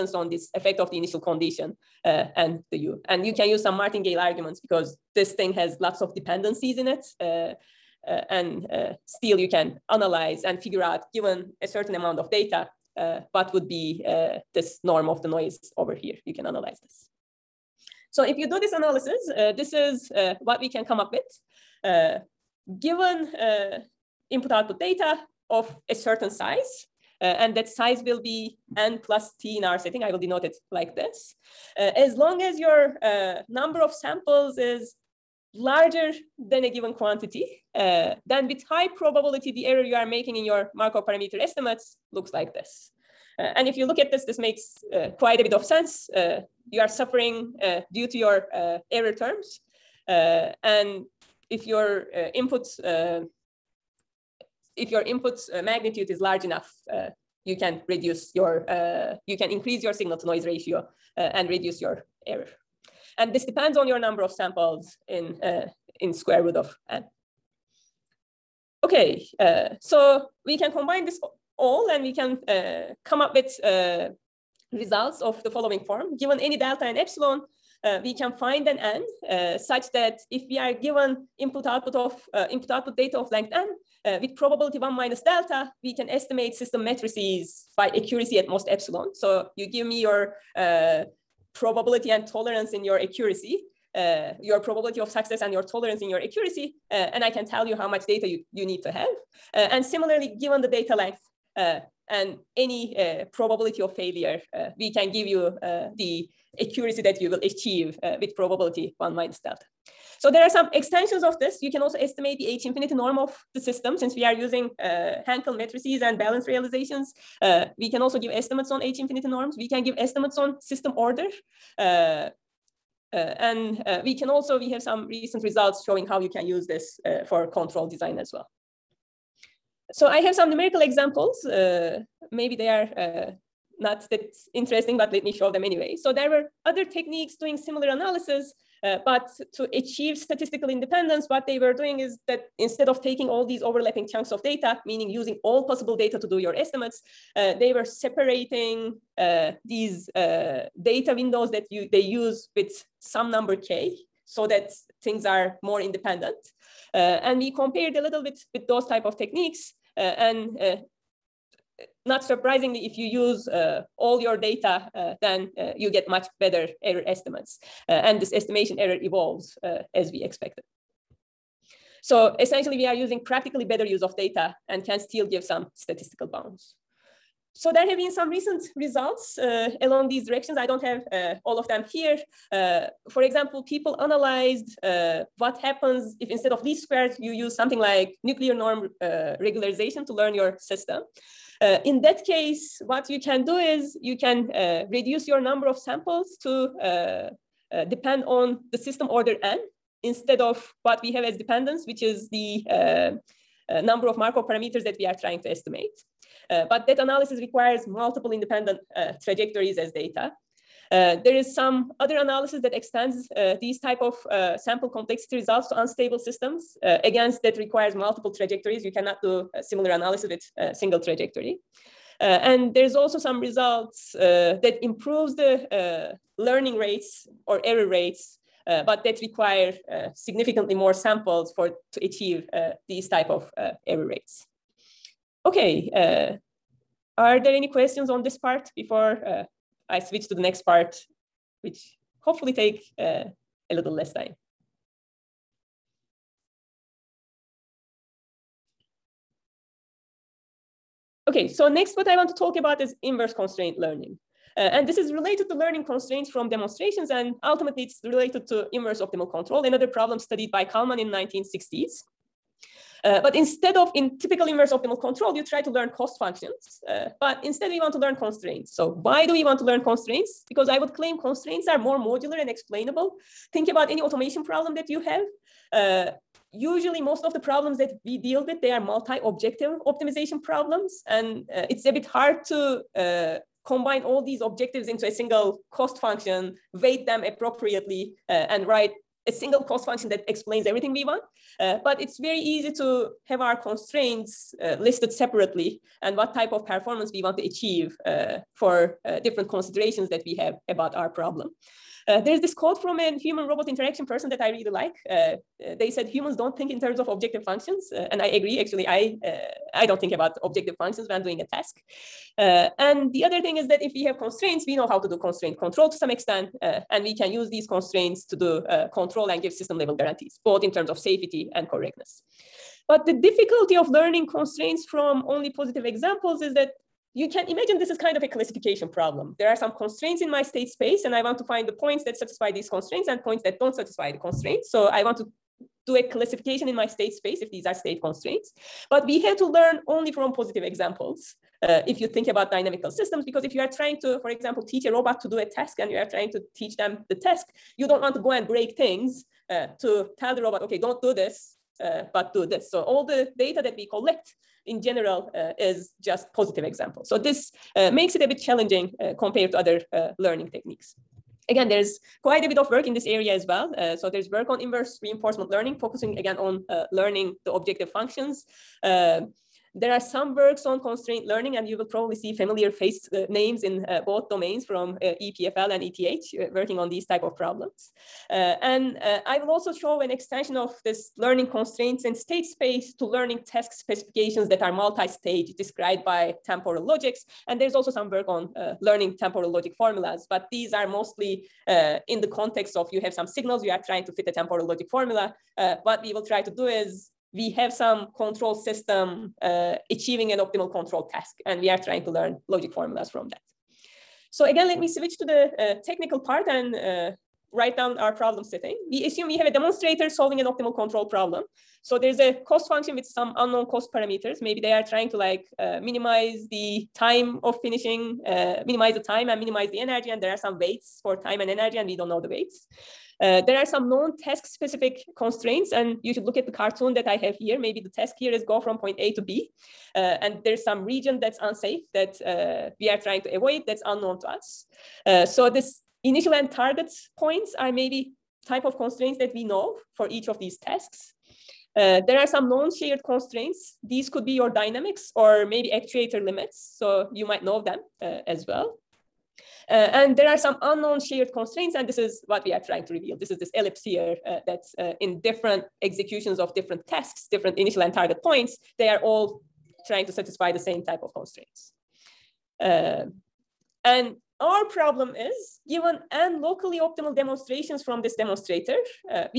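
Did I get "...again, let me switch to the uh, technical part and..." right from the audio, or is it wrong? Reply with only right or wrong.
right.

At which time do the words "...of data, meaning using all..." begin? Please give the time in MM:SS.
02:24.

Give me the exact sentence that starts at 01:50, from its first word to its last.
So there are some extensions of this.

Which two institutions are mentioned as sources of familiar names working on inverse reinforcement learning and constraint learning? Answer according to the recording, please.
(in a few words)
EPFL and ETH.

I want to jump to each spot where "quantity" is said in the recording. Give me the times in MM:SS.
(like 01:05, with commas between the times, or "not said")
00:36.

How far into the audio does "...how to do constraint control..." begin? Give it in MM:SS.
05:14.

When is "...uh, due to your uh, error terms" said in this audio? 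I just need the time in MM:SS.
00:47.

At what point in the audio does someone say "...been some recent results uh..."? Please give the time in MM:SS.
02:57.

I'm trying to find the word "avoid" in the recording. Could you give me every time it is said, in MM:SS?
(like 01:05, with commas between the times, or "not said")
07:13.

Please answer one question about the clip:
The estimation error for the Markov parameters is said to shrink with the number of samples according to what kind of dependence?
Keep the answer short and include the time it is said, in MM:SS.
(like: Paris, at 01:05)
square root of n, at 01:06.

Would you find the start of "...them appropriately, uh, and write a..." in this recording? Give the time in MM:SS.
04:47.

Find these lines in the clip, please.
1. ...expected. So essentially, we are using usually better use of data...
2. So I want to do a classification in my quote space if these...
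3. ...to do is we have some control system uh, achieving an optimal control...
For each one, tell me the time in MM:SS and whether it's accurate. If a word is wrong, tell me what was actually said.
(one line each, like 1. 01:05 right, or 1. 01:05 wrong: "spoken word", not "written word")
1. 02:50 wrong: "practically", not "usually"
2. 05:34 wrong: "state", not "quote"
3. 06:36 right.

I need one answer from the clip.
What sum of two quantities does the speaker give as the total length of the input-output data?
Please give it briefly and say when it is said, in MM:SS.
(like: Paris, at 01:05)
n plus t, at 00:28.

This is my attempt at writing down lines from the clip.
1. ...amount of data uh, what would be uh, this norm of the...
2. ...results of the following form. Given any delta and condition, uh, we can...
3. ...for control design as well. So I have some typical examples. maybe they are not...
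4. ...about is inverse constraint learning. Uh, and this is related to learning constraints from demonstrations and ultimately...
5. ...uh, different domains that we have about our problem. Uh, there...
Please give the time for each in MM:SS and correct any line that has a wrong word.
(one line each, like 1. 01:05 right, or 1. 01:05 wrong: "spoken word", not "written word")
1. 00:11 right
2. 01:14 wrong: "epsilon", not "condition"
3. 02:07 wrong: "numerical", not "typical"
4. 04:12 right
5. 04:59 wrong: "considerations", not "domains".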